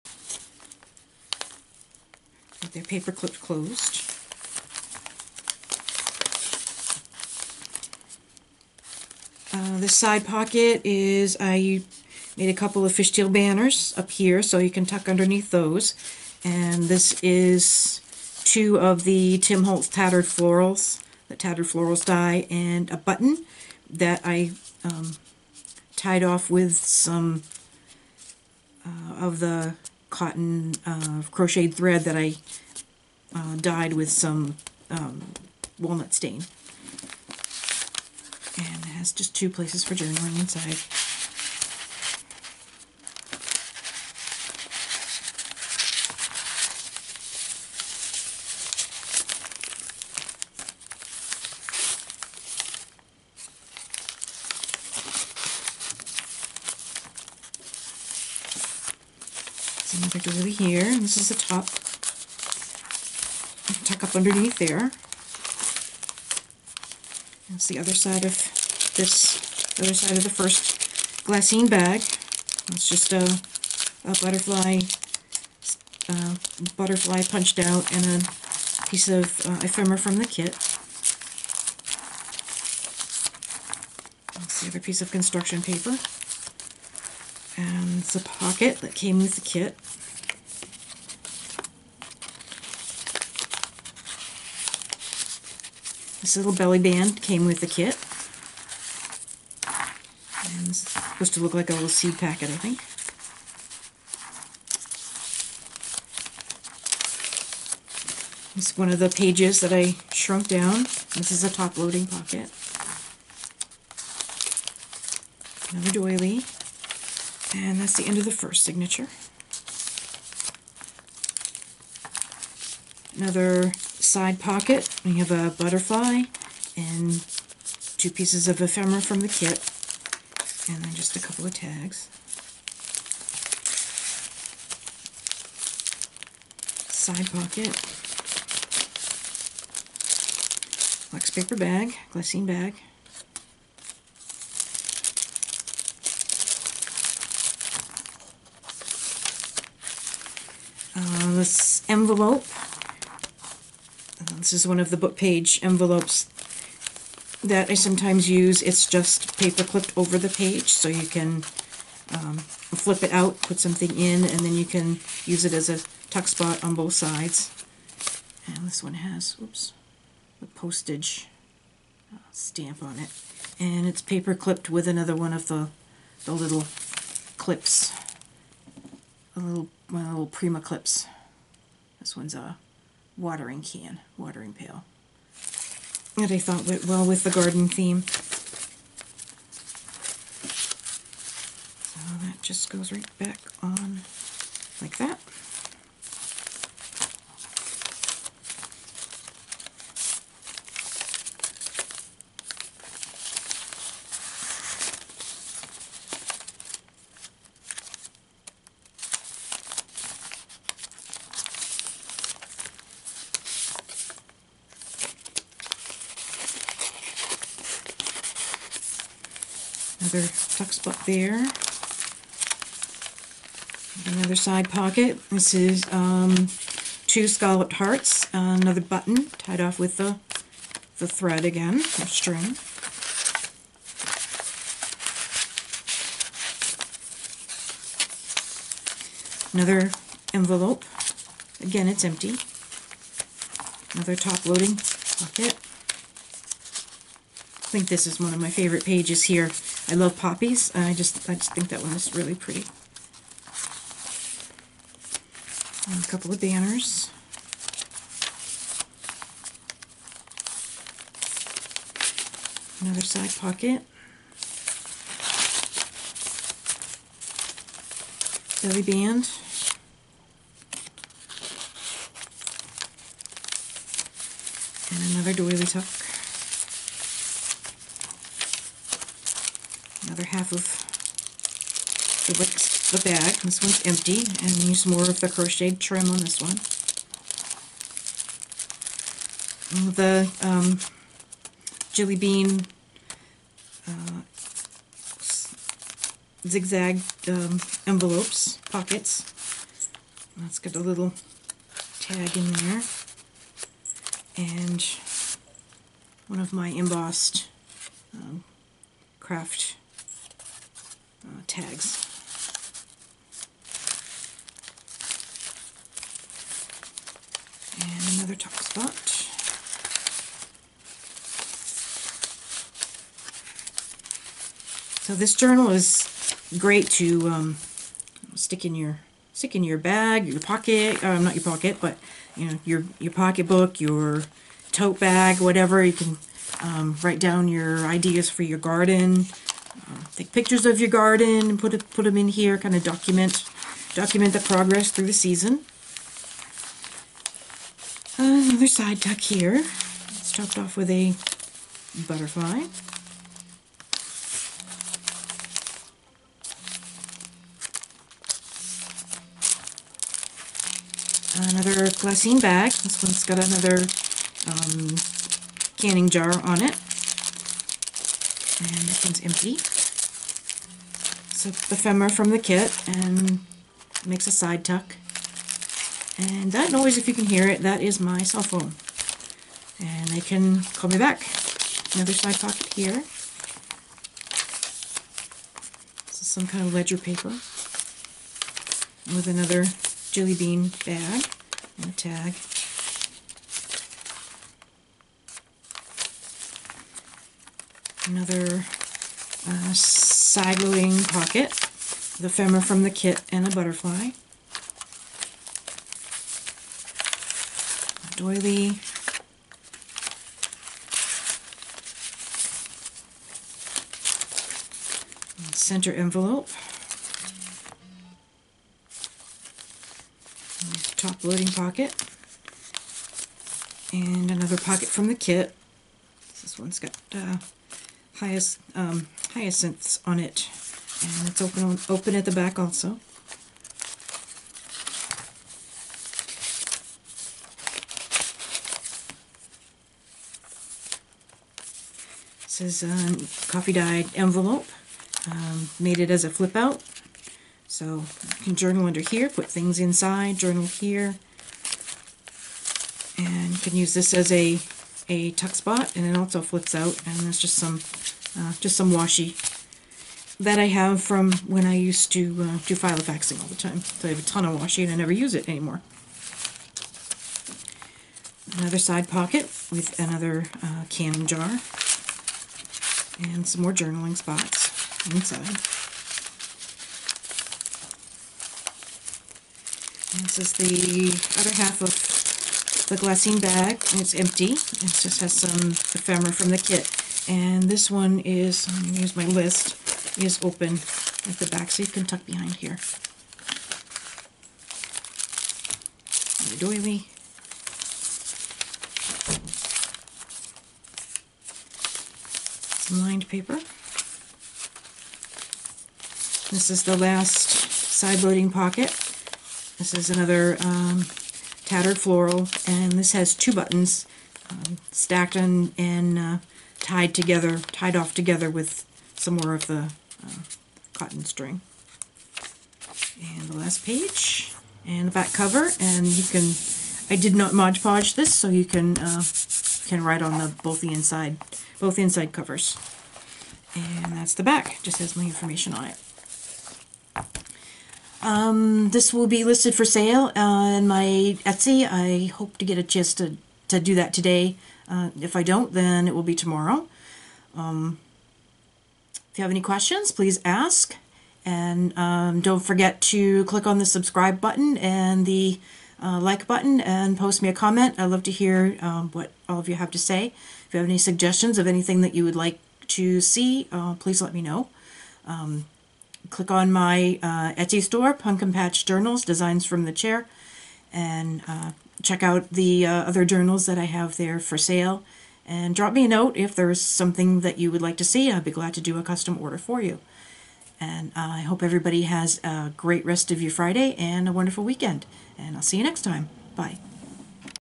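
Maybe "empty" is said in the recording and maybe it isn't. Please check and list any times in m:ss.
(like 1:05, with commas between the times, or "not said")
4:02, 4:43, 6:09, 8:04.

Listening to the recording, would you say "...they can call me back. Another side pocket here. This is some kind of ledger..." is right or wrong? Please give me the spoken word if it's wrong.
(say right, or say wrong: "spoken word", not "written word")
right.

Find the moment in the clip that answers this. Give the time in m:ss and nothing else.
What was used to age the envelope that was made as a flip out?
7:23.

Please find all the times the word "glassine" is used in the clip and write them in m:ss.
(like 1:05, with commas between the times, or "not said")
1:11, 2:22, 6:01, 8:02.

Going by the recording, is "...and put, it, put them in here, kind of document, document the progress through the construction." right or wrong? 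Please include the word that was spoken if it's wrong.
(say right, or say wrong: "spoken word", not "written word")
wrong: "season", not "construction".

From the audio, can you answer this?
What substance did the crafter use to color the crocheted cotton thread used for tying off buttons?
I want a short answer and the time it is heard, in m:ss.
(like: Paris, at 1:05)
Walnut stain, at 0:35.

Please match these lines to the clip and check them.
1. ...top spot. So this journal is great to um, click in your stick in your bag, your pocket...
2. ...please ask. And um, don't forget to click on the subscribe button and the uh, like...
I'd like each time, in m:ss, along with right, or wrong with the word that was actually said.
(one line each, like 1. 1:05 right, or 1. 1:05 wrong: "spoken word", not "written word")
1. 5:18 wrong: "stick", not "click"
2. 9:10 right.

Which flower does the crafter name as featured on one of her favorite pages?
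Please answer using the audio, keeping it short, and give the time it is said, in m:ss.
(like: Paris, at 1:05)
Poppies, at 4:10.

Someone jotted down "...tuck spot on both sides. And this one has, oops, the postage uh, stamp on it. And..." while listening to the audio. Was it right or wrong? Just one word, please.
right.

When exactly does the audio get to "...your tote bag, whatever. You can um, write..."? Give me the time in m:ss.
5:33.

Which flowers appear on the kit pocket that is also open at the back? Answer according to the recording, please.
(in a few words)
Hyacinths.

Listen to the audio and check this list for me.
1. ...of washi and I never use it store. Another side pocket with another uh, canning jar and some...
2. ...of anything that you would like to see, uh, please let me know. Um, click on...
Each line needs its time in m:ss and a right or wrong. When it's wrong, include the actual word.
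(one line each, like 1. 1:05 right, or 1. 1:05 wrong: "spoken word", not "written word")
1. 7:44 wrong: "anymore", not "store"
2. 9:21 right.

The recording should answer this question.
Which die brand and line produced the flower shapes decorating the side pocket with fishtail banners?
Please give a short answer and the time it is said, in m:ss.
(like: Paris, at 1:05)
Tim Holtz Tattered Florals, at 0:19.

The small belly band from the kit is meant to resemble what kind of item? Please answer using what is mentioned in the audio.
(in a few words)
Seed packet.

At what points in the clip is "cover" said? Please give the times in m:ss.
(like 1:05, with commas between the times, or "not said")
8:45, 8:52.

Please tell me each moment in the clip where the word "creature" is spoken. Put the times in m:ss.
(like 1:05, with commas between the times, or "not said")
not said.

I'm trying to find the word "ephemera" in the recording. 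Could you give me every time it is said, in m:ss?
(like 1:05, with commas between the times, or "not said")
1:19, 2:08, 6:11, 6:42, 8:05.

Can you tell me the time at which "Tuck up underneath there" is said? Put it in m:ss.
1:03.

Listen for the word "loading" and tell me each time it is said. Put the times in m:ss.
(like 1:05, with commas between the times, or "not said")
1:51, 4:04, 6:40, 7:01, 8:28.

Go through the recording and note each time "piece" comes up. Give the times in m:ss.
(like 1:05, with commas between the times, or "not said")
1:18, 1:24, 2:08.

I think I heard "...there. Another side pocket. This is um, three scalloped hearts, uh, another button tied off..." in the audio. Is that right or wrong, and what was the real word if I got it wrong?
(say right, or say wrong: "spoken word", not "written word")
wrong: "two", not "three".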